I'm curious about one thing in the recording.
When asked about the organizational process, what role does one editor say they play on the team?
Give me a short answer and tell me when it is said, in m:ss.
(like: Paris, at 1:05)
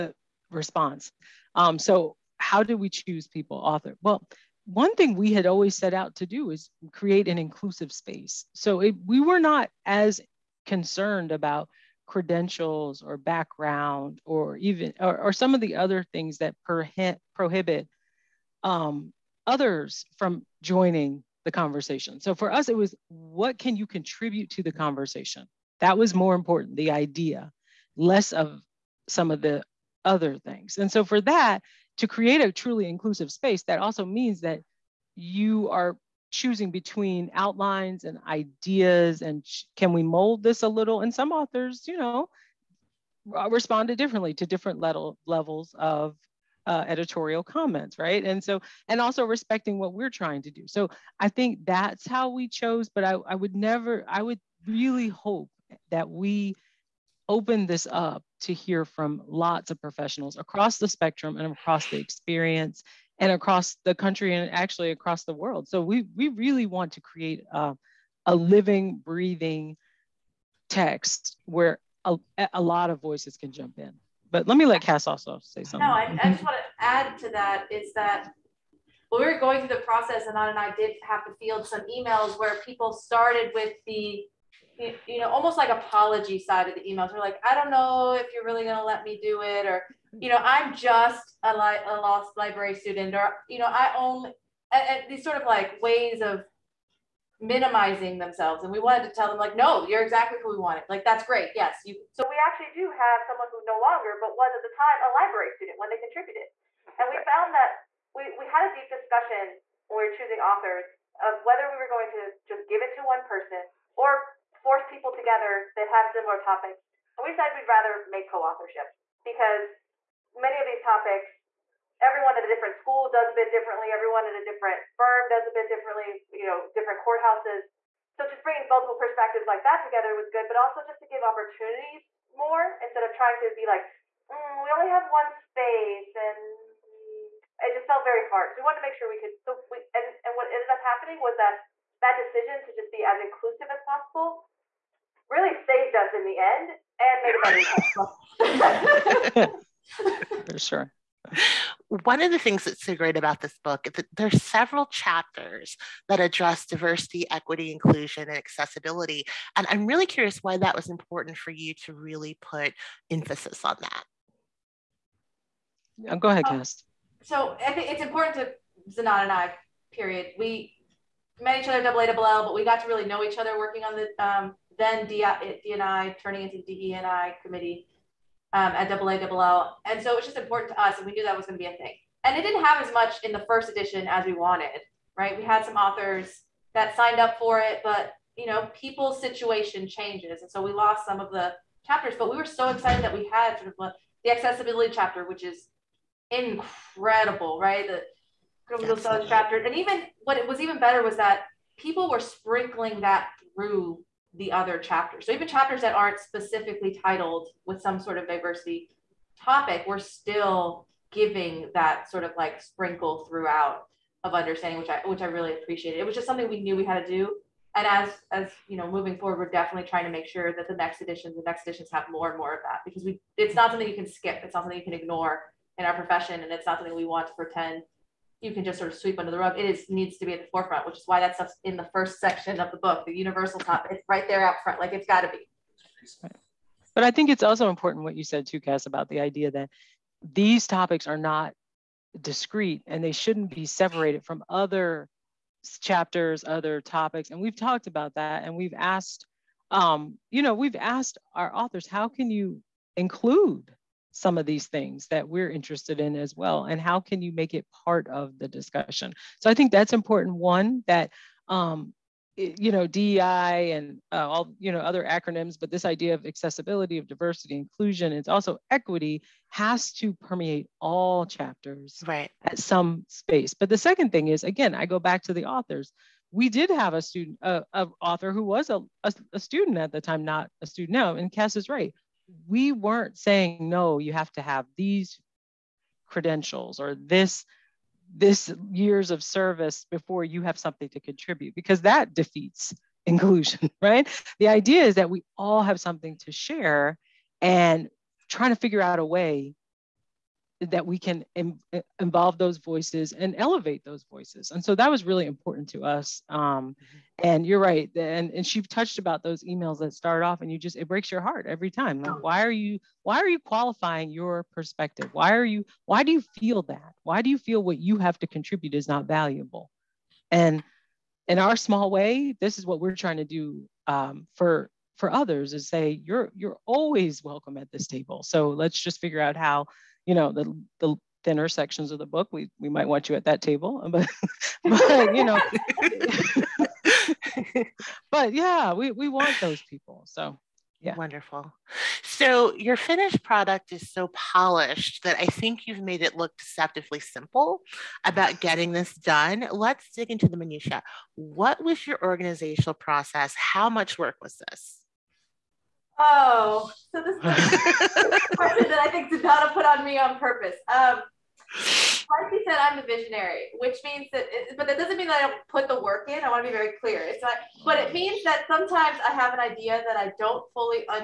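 the visionary, at 6:02.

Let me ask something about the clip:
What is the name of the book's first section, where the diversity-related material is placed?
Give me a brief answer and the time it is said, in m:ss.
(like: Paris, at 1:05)
universal topic, at 3:53.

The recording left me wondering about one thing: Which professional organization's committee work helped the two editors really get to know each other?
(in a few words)
AALL.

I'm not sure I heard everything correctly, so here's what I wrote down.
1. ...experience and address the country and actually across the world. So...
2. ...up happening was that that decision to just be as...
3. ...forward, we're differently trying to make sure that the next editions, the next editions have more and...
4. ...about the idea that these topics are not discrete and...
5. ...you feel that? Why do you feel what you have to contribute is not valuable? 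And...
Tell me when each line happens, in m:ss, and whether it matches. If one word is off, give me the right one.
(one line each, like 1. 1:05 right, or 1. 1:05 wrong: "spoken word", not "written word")
1. 1:01 wrong: "across", not "address"
2. 2:20 right
3. 3:39 wrong: "definitely", not "differently"
4. 3:58 right
5. 5:16 right.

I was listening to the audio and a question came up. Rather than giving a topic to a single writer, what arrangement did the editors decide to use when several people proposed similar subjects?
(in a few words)
co-authorship.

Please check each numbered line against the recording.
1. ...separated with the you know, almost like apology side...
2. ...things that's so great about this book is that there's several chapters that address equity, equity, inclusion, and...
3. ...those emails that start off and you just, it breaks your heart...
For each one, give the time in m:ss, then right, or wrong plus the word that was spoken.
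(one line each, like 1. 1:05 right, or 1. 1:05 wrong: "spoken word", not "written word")
1. 1:22 wrong: "started", not "separated"
2. 2:32 wrong: "diversity", not "equity"
3. 5:09 right.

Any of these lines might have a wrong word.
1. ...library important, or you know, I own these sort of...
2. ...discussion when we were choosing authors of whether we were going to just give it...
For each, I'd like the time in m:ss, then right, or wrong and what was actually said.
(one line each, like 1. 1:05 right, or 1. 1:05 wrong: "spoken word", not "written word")
1. 1:32 wrong: "student", not "important"
2. 1:48 right.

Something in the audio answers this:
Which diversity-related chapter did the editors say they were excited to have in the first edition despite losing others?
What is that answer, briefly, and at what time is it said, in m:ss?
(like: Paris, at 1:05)
accessibility chapter, at 3:14.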